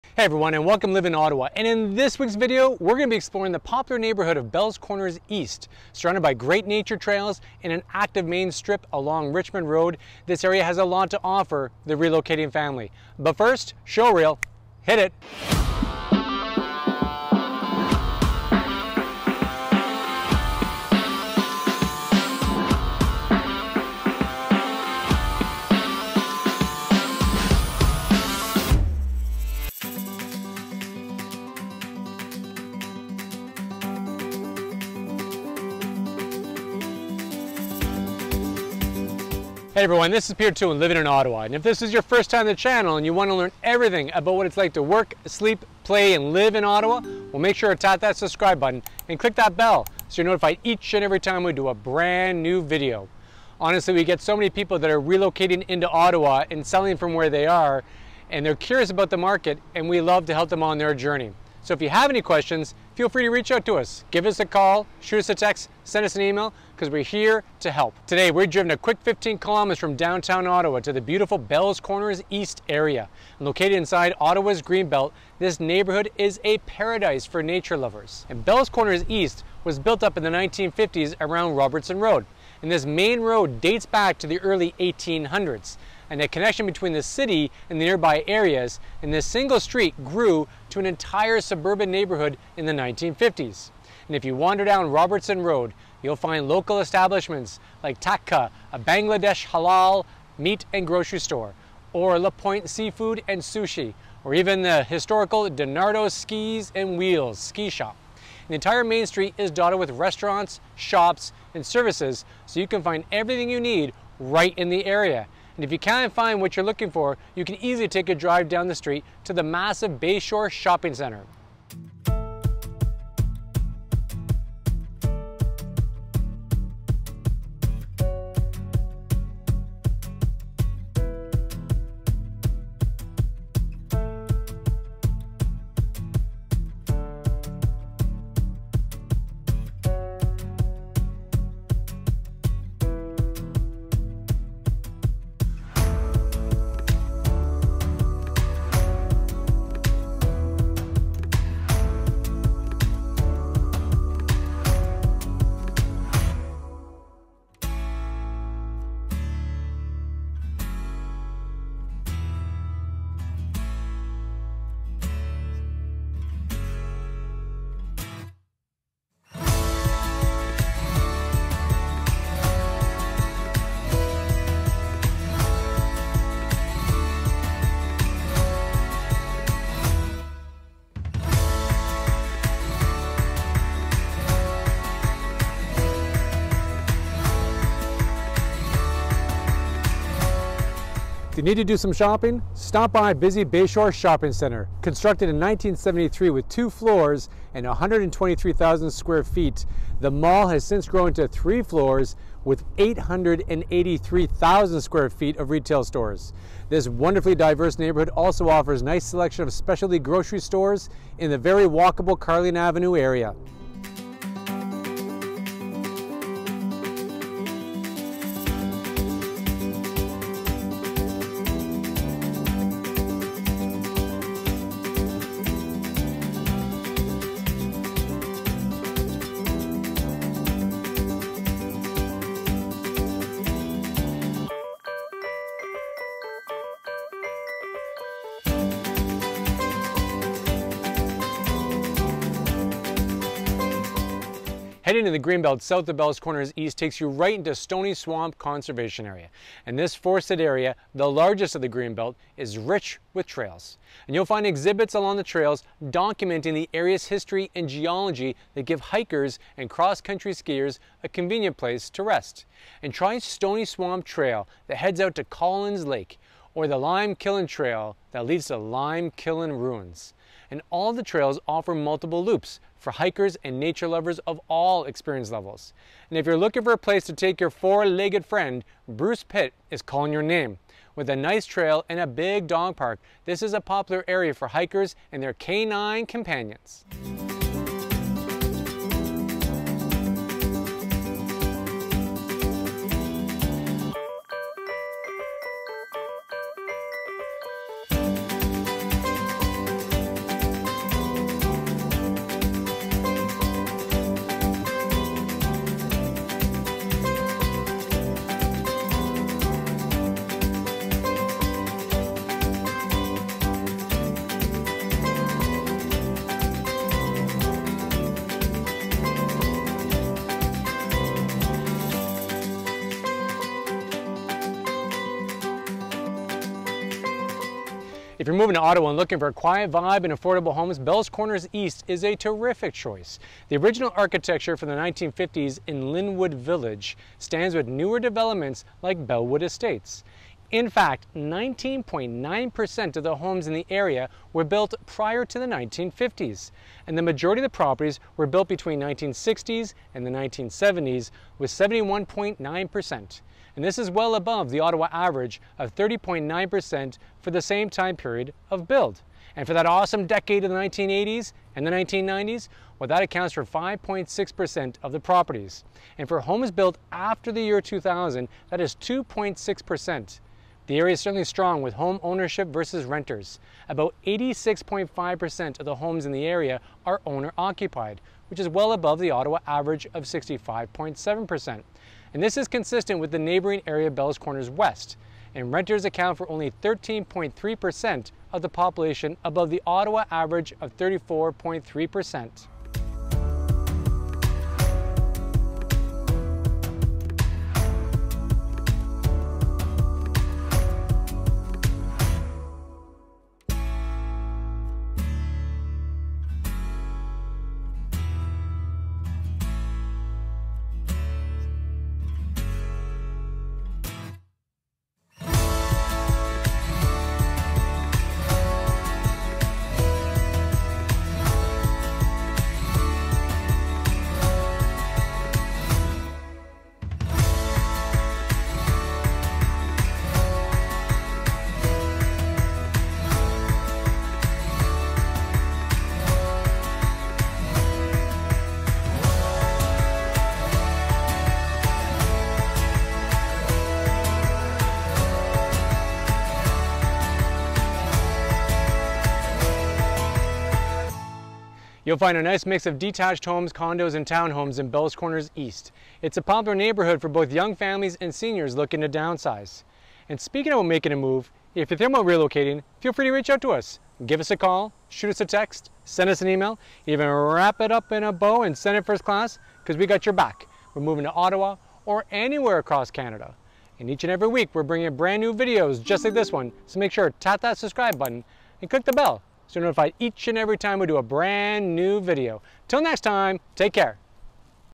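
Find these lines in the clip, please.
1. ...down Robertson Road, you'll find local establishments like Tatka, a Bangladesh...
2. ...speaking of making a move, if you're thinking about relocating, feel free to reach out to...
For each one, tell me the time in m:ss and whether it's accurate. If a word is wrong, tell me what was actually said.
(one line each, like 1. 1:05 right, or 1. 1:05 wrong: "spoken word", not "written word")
1. 1:34 right
2. 7:40 right.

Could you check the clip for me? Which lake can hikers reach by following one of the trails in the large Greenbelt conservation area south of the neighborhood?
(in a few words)
Collins Lake.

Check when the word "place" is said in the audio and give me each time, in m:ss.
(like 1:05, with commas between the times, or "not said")
4:21, 4:36.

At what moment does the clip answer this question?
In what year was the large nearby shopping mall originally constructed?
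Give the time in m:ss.
3:15.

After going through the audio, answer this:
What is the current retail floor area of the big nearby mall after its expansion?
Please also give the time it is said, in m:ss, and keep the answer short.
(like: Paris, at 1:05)
883,000 square feet, at 3:22.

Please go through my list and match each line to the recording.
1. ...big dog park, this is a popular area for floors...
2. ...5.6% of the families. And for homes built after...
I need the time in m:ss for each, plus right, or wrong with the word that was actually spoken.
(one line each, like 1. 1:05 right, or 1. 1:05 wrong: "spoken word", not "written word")
1. 4:42 wrong: "hikers", not "floors"
2. 6:03 wrong: "properties", not "families".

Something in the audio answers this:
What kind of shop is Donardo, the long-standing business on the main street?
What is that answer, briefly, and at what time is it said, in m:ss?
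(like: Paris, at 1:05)
Skis and Wheels ski shop, at 1:46.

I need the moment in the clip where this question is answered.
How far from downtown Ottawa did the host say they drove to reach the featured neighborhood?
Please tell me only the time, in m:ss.
1:09.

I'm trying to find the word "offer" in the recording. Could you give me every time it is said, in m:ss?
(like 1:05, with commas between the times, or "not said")
0:11, 3:28, 4:31.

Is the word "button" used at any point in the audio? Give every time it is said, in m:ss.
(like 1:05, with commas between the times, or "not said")
0:48, 7:57.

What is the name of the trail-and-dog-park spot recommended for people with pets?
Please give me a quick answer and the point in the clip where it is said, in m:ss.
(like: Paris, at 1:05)
Bruce Pit, at 4:38.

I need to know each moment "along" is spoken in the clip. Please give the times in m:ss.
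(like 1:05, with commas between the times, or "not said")
0:08, 4:14.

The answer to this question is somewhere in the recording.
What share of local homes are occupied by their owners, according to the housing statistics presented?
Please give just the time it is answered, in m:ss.
6:14.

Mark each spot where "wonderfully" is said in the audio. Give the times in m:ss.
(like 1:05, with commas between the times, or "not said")
3:26.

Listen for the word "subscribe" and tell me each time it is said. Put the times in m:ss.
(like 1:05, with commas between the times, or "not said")
0:48, 7:57.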